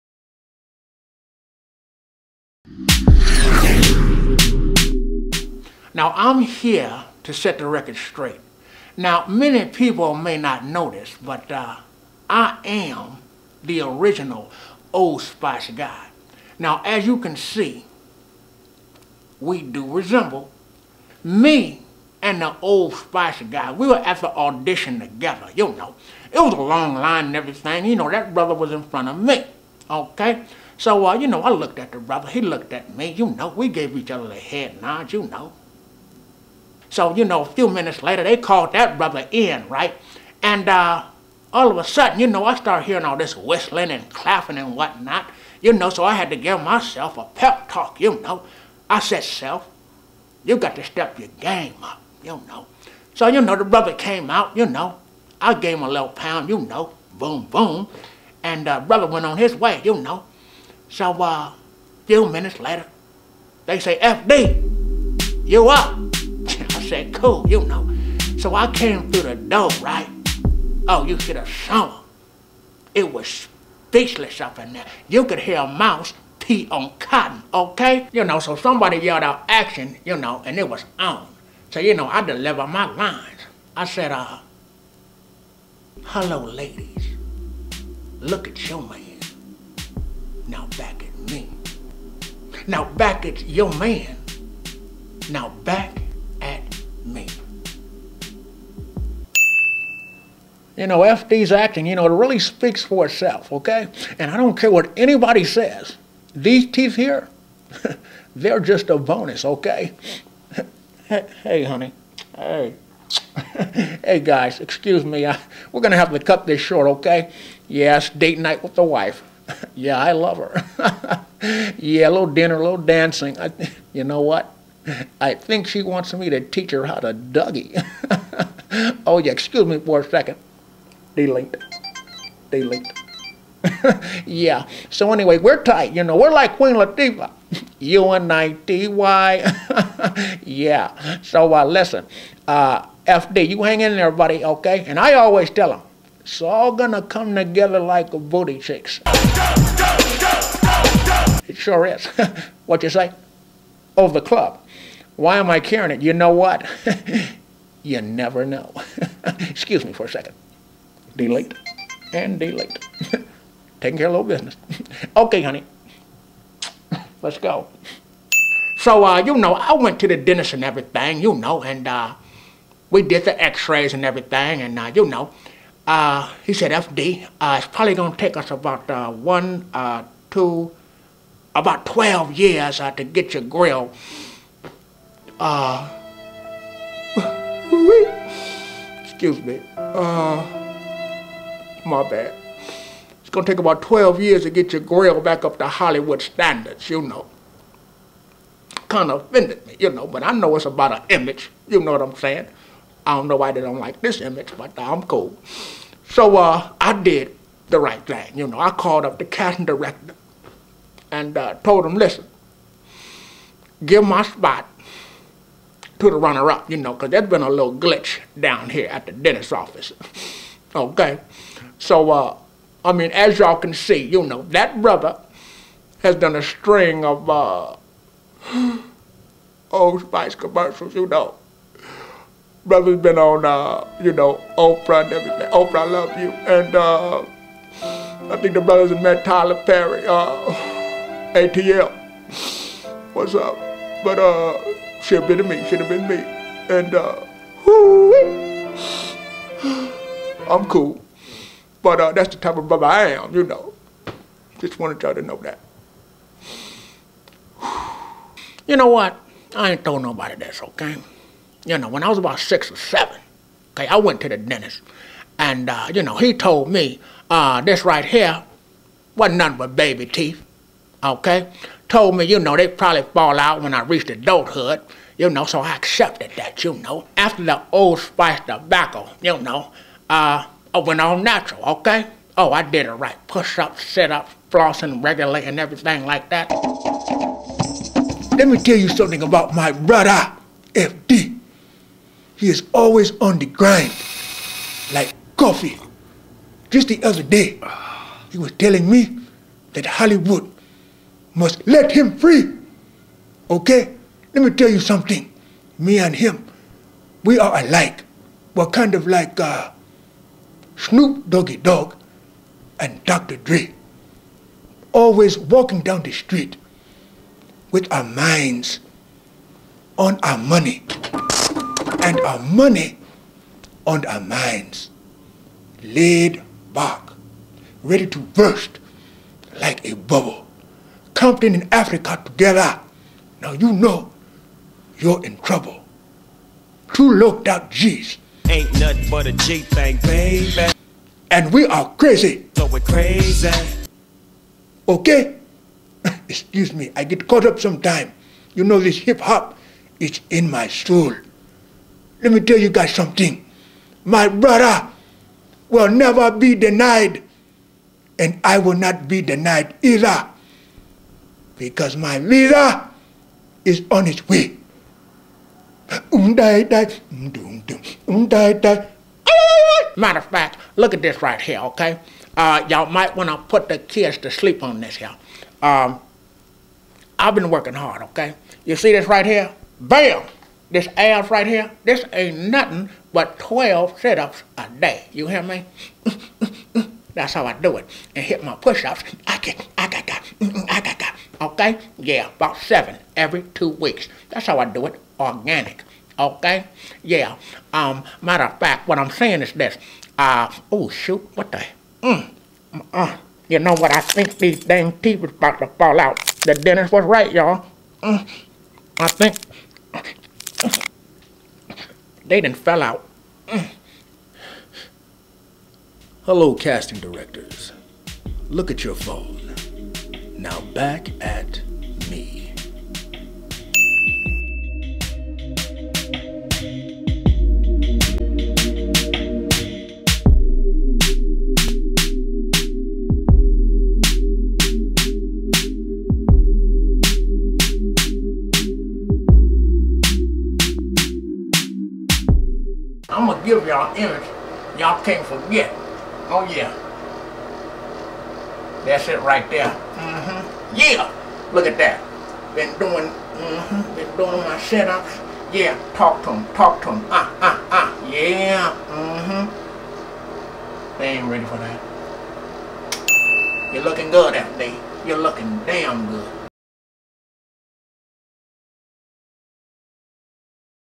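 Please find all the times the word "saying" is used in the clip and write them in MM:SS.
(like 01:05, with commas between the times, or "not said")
03:22, 06:39.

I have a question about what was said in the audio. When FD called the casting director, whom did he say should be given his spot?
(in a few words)
the runner-up.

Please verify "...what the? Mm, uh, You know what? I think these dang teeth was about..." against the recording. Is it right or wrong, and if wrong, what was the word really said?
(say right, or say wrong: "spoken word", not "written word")
right.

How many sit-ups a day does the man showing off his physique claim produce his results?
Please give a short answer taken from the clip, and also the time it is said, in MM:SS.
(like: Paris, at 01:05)
12, at 06:23.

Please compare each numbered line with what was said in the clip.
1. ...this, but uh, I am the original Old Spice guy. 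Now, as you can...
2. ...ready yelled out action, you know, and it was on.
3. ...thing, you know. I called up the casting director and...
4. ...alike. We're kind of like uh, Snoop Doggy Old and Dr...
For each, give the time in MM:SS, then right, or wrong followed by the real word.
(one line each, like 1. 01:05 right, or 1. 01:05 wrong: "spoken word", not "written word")
1. 00:10 right
2. 01:18 wrong: "somebody", not "ready"
3. 03:28 right
4. 05:07 wrong: "Dogg", not "Old".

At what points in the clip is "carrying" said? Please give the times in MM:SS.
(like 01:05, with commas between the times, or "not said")
02:35.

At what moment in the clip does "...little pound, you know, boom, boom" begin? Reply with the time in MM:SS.
00:55.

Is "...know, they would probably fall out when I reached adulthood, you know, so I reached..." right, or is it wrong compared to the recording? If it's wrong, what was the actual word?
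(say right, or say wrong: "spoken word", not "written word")
wrong: "accepted", not "reached".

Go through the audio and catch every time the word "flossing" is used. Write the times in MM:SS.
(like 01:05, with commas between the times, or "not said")
04:44.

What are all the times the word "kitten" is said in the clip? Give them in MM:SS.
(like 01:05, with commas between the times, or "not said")
not said.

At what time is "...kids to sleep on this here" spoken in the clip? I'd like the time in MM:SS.
06:13.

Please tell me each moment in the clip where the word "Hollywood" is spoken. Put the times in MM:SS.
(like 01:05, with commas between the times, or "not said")
03:15, 04:59.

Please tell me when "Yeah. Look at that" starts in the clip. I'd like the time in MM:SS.
07:30.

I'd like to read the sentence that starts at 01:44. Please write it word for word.
And I don't care what anybody says.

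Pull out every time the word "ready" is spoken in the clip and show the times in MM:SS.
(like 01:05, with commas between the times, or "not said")
05:27, 07:41.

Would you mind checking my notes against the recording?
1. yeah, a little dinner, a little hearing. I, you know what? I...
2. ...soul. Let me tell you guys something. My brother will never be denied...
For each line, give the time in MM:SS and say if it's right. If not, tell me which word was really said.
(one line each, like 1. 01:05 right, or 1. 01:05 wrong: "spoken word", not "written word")
1. 02:01 wrong: "dancing", not "hearing"
2. 05:50 right.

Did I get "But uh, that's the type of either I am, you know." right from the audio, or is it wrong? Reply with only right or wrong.
wrong.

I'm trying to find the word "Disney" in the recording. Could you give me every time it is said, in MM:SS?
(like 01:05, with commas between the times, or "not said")
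not said.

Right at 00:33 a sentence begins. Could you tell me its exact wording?
We gave each other the head nod, you know.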